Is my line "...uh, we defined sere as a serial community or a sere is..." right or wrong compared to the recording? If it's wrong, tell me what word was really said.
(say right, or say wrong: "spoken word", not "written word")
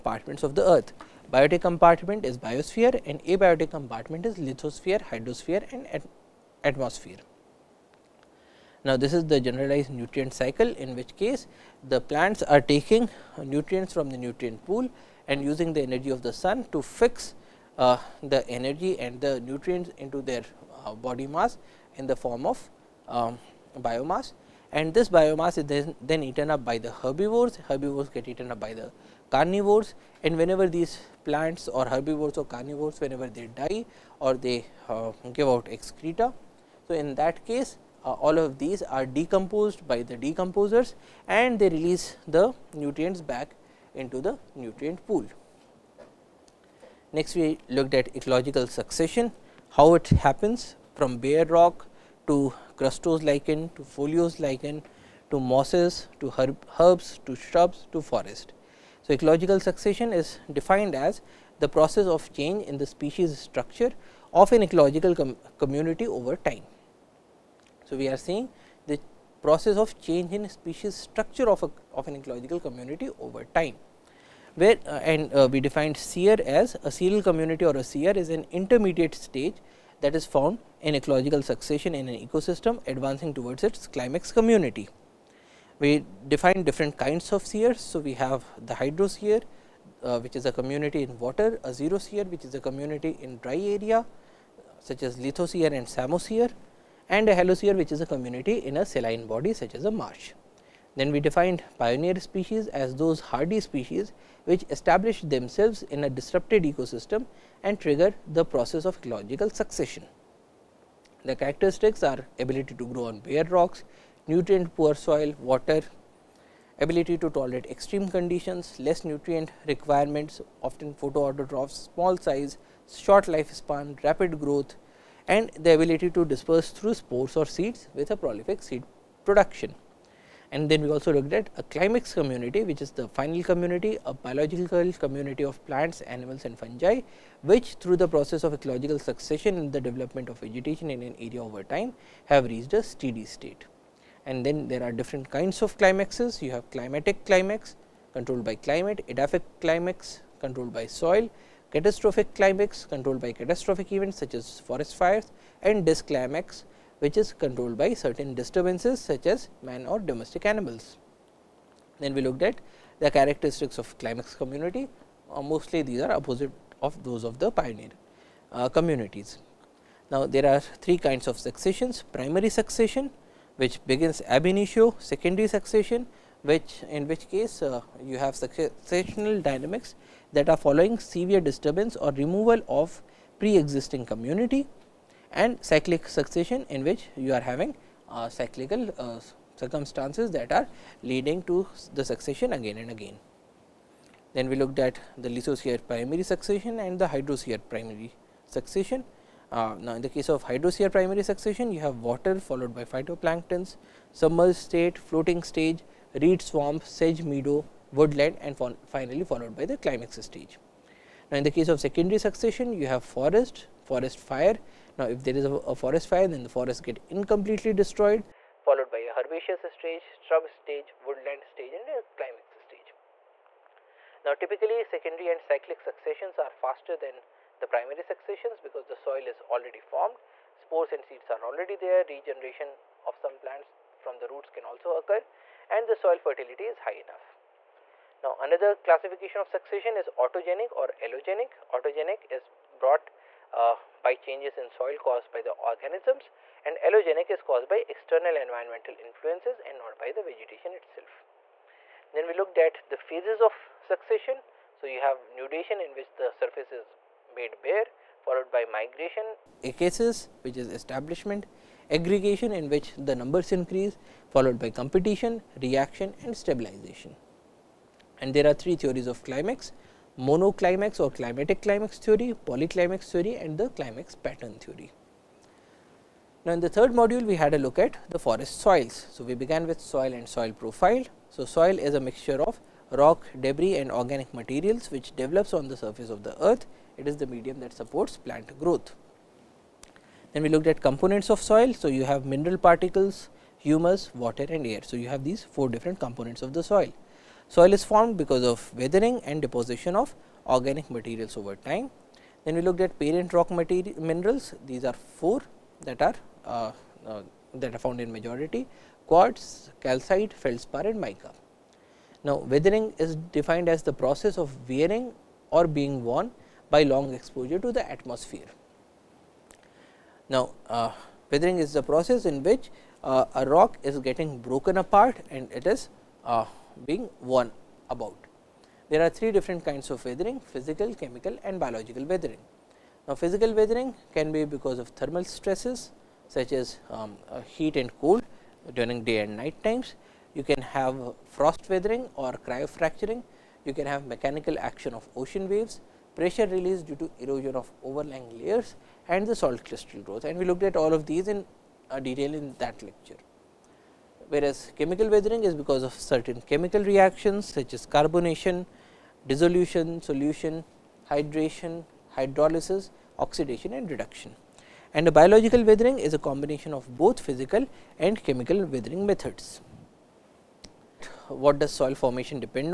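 right.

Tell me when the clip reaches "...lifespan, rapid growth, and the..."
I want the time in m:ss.
2:03.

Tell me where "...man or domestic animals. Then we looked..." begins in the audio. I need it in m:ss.
2:39.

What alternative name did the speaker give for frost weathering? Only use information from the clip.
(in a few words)
cryofracturing.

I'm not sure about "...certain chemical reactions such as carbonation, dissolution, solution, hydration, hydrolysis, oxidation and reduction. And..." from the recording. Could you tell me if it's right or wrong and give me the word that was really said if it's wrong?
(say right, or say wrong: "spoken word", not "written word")
right.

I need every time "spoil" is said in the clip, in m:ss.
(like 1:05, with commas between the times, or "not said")
not said.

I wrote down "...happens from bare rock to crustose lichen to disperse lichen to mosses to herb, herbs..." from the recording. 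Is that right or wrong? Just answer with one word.
wrong.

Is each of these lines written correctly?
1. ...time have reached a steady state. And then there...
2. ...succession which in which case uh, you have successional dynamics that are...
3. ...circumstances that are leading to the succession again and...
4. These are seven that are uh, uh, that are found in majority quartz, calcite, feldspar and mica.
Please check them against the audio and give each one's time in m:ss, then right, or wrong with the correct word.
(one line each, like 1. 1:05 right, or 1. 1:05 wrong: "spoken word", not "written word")
1. 2:21 right
2. 2:55 right
3. 3:09 right
4. 5:04 wrong: "four", not "seven".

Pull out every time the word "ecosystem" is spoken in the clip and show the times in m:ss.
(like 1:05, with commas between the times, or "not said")
1:22, 1:46.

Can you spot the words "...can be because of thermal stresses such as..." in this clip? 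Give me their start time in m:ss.
5:34.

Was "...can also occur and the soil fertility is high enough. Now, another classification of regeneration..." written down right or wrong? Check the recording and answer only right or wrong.
wrong.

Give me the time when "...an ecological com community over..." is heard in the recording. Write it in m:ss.
1:04.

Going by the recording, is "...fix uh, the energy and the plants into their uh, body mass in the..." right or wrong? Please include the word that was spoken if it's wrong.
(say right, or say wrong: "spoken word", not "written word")
wrong: "nutrients", not "plants".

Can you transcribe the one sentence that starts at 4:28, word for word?
And there are three theories of climax monoclimax or climatic climax theory, polyclimax theory and the climax pattern theory.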